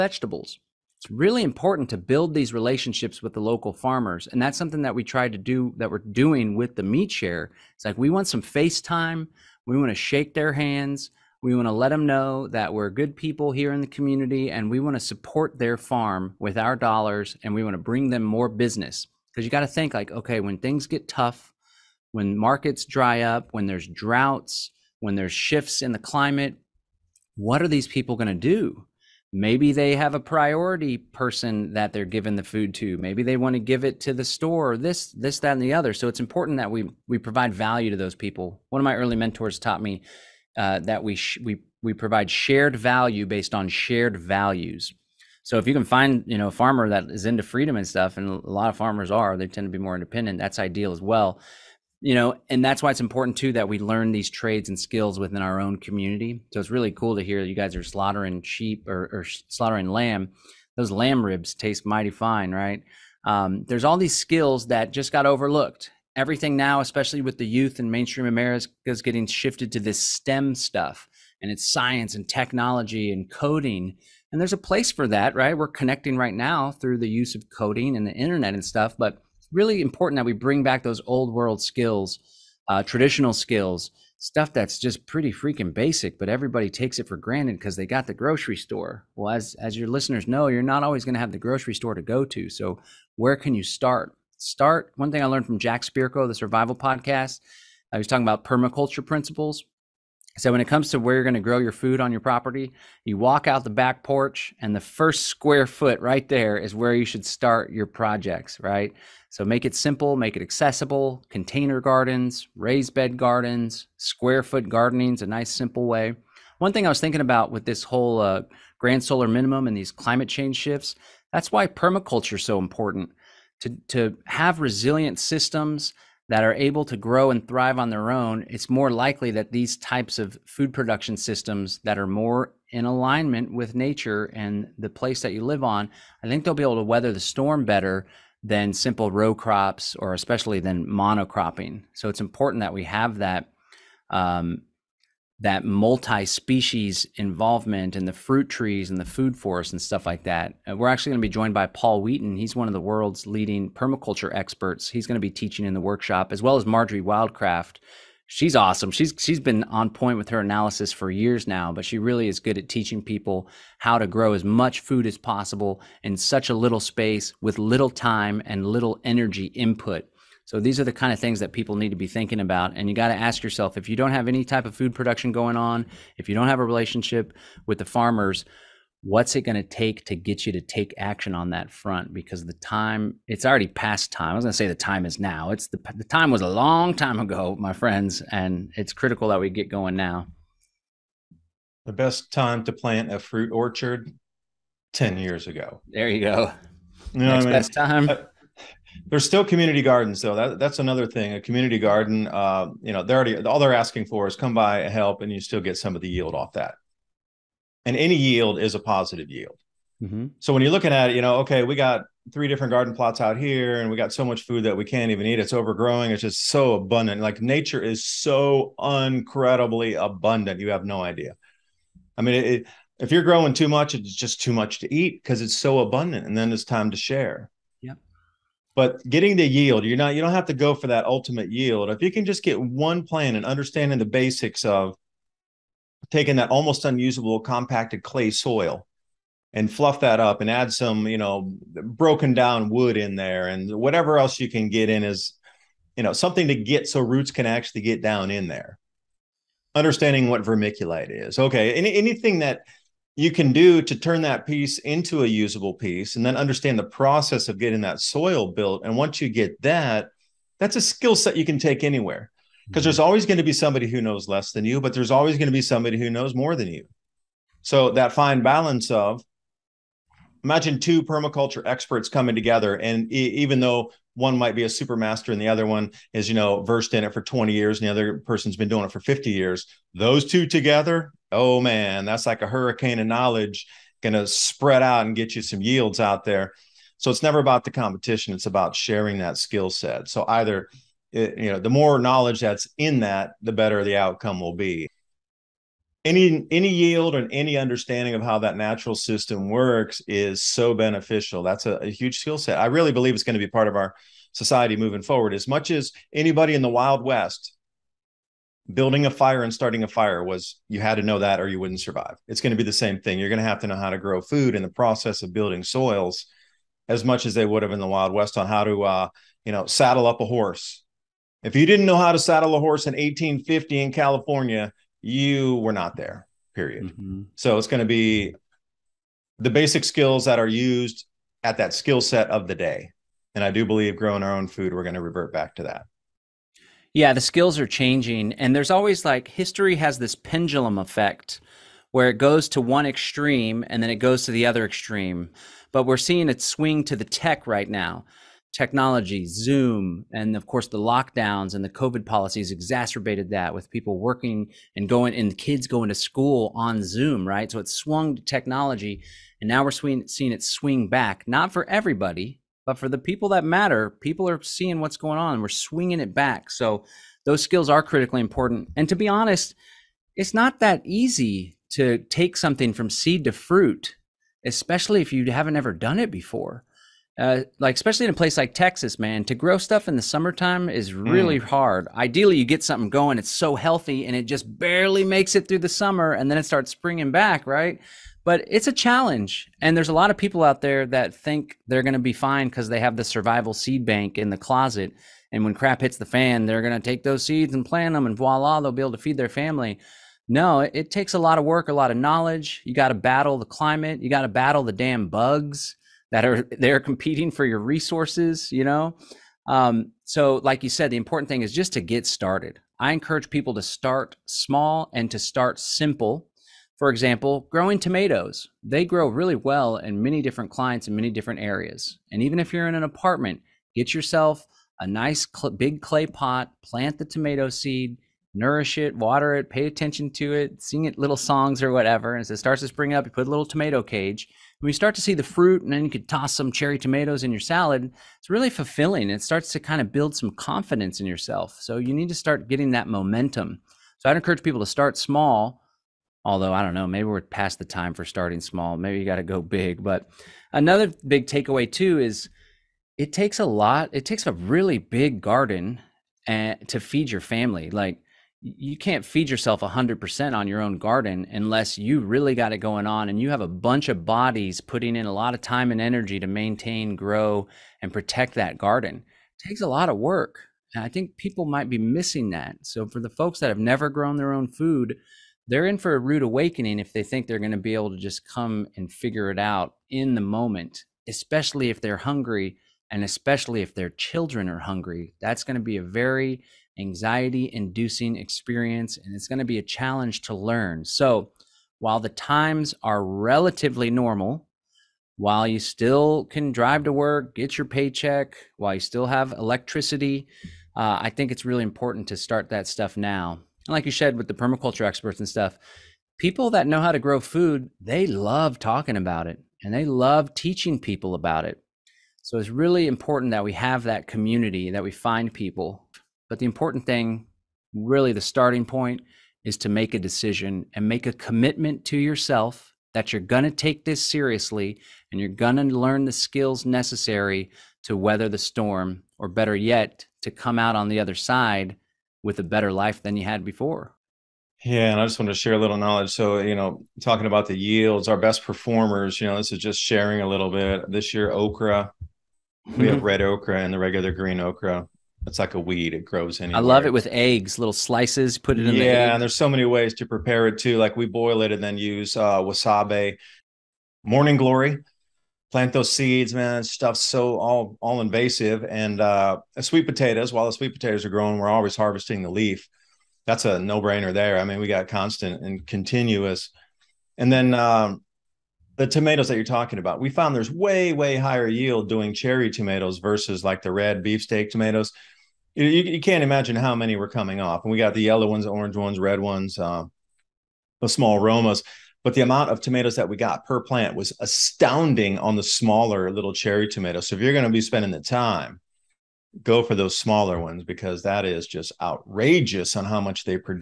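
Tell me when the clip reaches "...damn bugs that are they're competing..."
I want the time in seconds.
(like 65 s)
404 s.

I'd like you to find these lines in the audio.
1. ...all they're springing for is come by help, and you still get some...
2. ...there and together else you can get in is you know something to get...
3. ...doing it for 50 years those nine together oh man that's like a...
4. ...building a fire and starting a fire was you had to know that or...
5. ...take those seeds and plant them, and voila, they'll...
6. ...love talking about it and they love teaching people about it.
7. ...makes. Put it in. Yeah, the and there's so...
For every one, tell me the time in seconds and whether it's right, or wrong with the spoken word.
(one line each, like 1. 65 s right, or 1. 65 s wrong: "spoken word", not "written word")
1. 203 s wrong: "asking", not "springing"
2. 243 s wrong: "whatever", not "together"
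3. 278 s wrong: "two", not "nine"
4. 308 s right
5. 396 s right
6. 508 s right
7. 547 s wrong: "slices", not "makes".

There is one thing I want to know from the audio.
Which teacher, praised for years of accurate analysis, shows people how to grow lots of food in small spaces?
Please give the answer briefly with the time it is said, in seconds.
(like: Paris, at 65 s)
Marjory Wildcraft, at 156 s.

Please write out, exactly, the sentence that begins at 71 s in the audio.
And it's science and technology and coding and there's a place for that, right?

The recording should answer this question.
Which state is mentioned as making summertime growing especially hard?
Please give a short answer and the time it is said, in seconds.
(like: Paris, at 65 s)
Texas, at 378 s.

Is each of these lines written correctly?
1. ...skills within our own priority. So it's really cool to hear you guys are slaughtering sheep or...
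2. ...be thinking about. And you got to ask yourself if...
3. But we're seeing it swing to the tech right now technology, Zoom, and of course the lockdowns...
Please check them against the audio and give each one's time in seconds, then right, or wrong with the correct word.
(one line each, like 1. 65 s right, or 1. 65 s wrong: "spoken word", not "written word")
1. 54 s wrong: "community", not "priority"
2. 171 s right
3. 345 s right.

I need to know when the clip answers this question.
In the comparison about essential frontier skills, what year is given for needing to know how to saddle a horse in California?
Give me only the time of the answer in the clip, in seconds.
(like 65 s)
322 s.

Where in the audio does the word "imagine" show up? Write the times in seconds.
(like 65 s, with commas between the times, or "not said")
270 s, 576 s.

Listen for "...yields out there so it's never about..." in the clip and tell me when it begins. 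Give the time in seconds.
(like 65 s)
285 s.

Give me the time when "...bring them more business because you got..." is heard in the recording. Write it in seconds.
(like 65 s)
17 s.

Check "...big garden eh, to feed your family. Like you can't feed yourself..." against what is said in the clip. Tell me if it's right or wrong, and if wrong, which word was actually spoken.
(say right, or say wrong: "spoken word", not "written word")
right.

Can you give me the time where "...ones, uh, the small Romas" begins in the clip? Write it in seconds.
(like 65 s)
579 s.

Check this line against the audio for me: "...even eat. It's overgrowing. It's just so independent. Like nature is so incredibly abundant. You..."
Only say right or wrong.
wrong.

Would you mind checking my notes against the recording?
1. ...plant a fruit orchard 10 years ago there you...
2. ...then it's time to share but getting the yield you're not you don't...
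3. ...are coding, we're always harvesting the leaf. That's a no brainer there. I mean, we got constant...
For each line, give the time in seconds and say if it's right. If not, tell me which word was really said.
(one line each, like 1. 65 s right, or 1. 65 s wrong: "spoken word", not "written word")
1. 192 s right
2. 226 s right
3. 561 s wrong: "growing", not "coding".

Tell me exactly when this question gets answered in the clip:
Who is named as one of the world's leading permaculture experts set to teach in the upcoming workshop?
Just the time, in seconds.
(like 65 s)
151 s.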